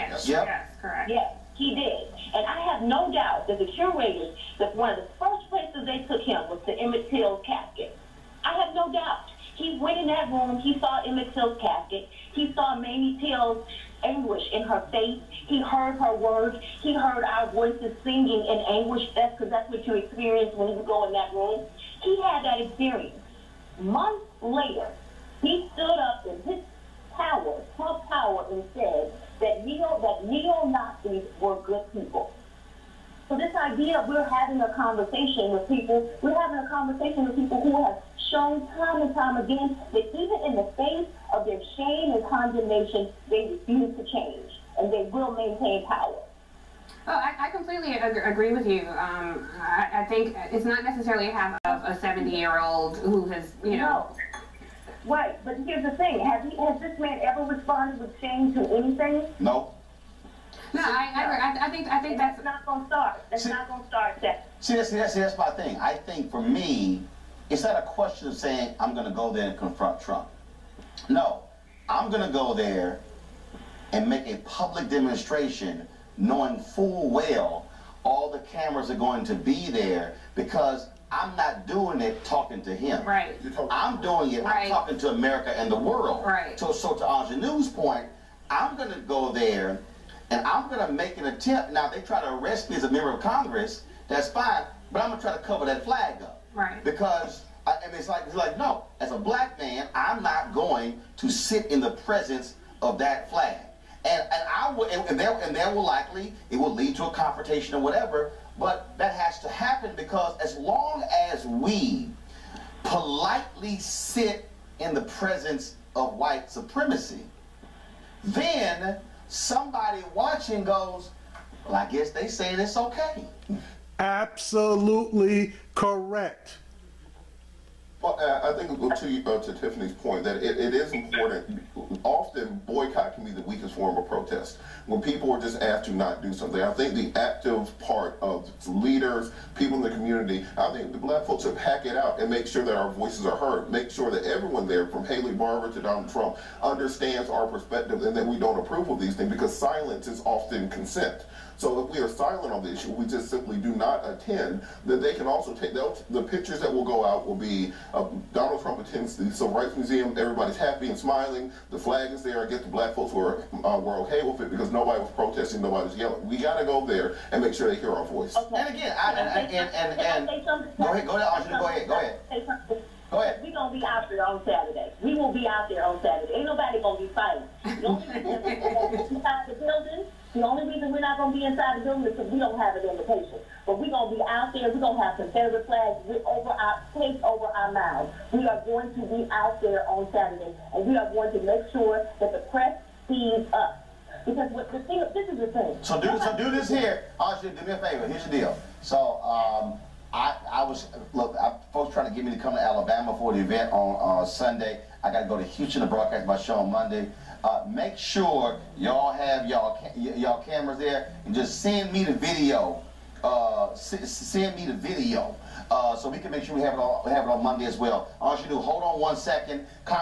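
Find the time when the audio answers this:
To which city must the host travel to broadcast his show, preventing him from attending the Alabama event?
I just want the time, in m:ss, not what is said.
3:25.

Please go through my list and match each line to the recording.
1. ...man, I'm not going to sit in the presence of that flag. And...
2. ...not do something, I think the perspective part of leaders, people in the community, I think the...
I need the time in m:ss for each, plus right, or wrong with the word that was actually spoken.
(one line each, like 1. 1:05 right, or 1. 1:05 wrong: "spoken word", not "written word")
1. 1:39 right
2. 2:15 wrong: "active", not "perspective".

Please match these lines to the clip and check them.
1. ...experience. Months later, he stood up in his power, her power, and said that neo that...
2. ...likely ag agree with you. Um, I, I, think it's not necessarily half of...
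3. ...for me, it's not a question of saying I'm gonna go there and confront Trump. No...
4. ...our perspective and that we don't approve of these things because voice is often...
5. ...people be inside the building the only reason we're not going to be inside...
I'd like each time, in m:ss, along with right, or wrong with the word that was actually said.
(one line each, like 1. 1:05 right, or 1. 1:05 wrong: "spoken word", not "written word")
1. 0:22 right
2. 0:47 wrong: "completely", not "likely"
3. 1:06 right
4. 2:27 wrong: "silence", not "voice"
5. 2:58 right.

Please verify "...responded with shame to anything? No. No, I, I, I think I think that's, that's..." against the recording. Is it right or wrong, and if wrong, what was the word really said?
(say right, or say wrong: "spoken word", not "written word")
right.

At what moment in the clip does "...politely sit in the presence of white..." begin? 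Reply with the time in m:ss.
1:52.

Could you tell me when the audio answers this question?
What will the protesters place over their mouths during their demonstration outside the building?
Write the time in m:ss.
3:05.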